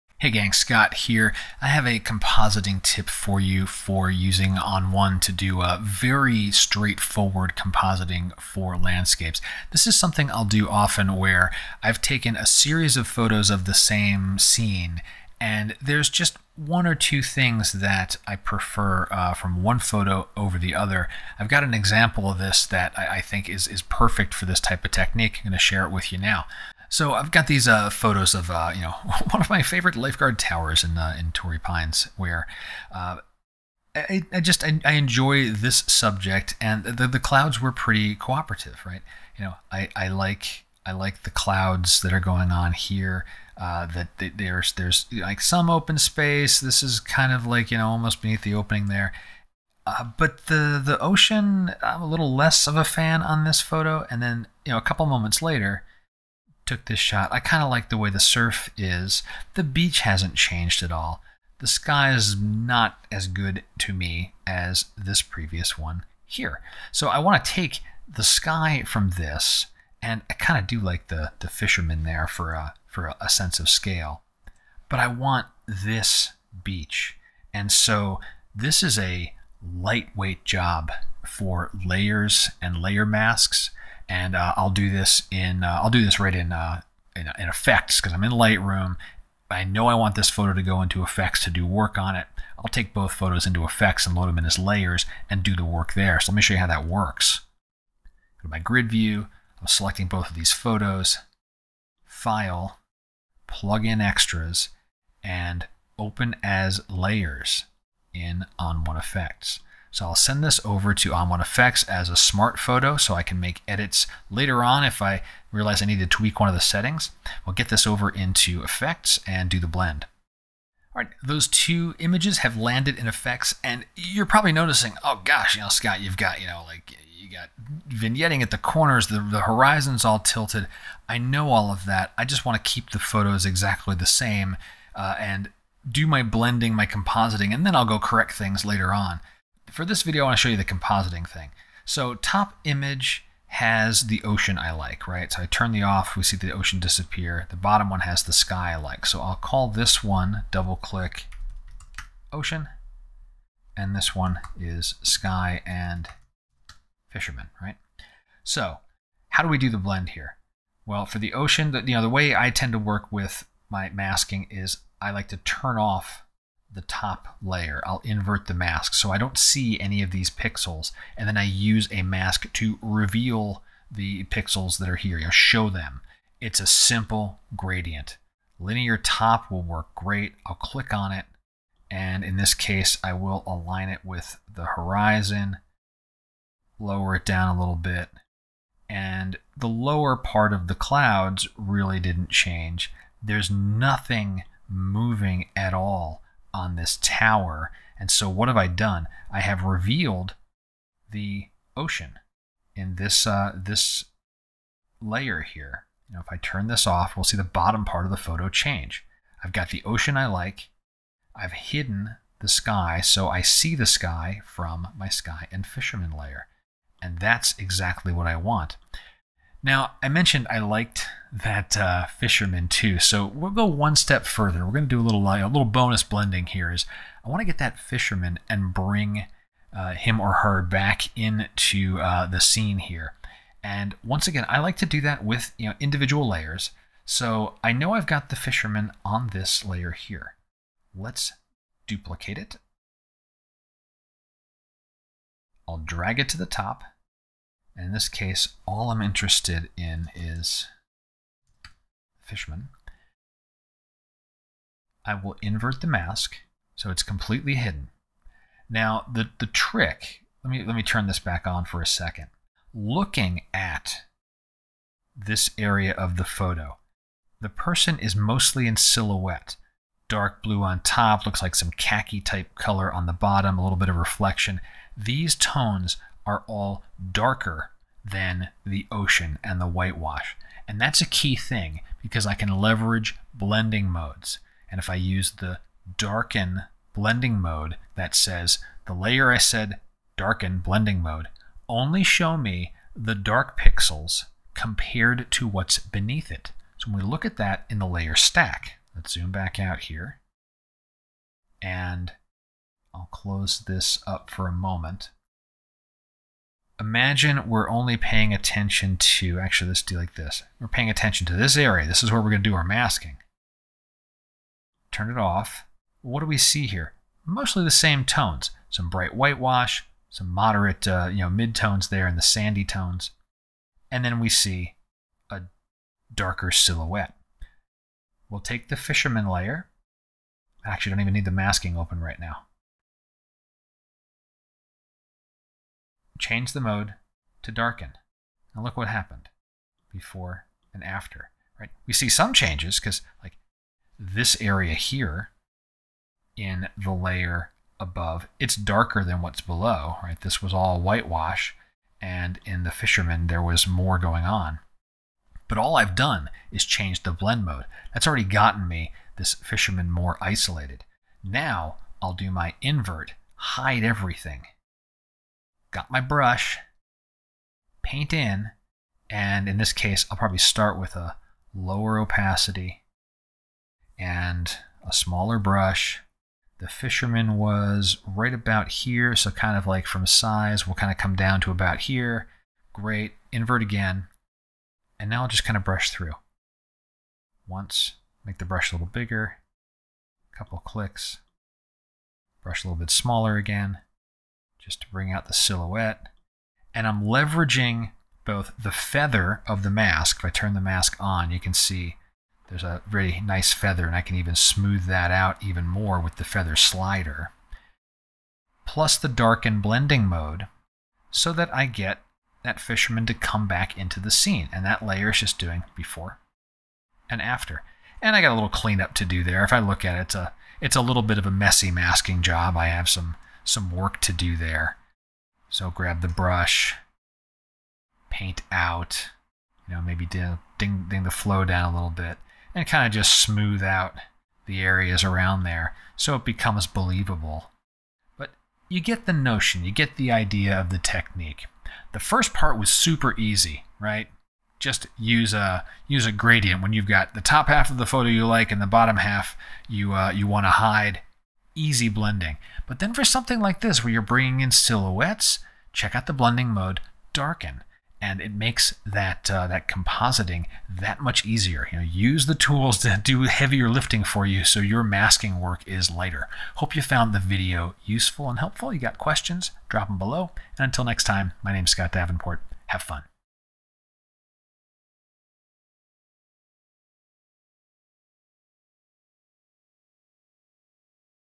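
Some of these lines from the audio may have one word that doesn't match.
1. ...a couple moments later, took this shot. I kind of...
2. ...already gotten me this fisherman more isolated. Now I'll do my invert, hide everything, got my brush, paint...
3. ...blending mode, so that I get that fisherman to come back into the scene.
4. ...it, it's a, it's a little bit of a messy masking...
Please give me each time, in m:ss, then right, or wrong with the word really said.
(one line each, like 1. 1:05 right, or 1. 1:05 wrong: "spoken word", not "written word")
1. 0:54 right
2. 5:58 right
3. 6:49 right
4. 6:59 right.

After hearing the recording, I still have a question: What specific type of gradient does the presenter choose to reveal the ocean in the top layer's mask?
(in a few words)
Linear top.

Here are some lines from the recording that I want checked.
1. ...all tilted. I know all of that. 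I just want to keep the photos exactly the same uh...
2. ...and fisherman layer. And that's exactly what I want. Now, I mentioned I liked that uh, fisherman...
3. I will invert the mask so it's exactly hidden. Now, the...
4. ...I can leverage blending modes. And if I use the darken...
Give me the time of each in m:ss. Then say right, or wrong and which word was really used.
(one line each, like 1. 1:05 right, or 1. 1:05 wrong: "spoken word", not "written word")
1. 2:10 right
2. 3:35 right
3. 4:15 wrong: "completely", not "exactly"
4. 4:42 right.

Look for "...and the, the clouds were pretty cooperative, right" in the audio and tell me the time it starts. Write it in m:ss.
0:36.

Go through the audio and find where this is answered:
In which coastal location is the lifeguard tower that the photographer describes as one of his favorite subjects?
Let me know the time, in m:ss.
0:31.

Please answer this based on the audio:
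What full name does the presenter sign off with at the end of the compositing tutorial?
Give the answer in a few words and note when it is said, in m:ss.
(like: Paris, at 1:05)
Scott Davenport, at 7:51.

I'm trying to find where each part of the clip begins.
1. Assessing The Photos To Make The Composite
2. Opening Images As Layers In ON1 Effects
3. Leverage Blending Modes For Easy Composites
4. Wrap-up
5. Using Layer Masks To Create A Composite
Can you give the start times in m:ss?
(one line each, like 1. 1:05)
1. 0:27
2. 1:18
3. 3:40
4. 7:21
5. 2:01.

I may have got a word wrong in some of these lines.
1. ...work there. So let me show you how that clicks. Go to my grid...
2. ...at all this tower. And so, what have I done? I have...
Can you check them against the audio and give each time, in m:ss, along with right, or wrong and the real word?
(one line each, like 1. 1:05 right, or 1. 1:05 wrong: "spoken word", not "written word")
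1. 1:35 wrong: "works", not "clicks"
2. 3:15 right.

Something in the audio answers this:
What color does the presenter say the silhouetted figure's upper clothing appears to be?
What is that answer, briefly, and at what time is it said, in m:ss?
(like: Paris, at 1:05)
Dark blue, at 4:30.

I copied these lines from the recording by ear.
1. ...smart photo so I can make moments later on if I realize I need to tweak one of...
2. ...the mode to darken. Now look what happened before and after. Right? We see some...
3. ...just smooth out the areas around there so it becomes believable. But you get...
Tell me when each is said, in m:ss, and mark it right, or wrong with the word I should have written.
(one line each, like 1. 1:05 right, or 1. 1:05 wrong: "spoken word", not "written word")
1. 1:52 wrong: "edits", not "moments"
2. 5:36 right
3. 7:12 right.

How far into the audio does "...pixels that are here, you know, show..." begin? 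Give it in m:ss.
2:54.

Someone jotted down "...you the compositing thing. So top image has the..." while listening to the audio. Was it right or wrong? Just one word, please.
right.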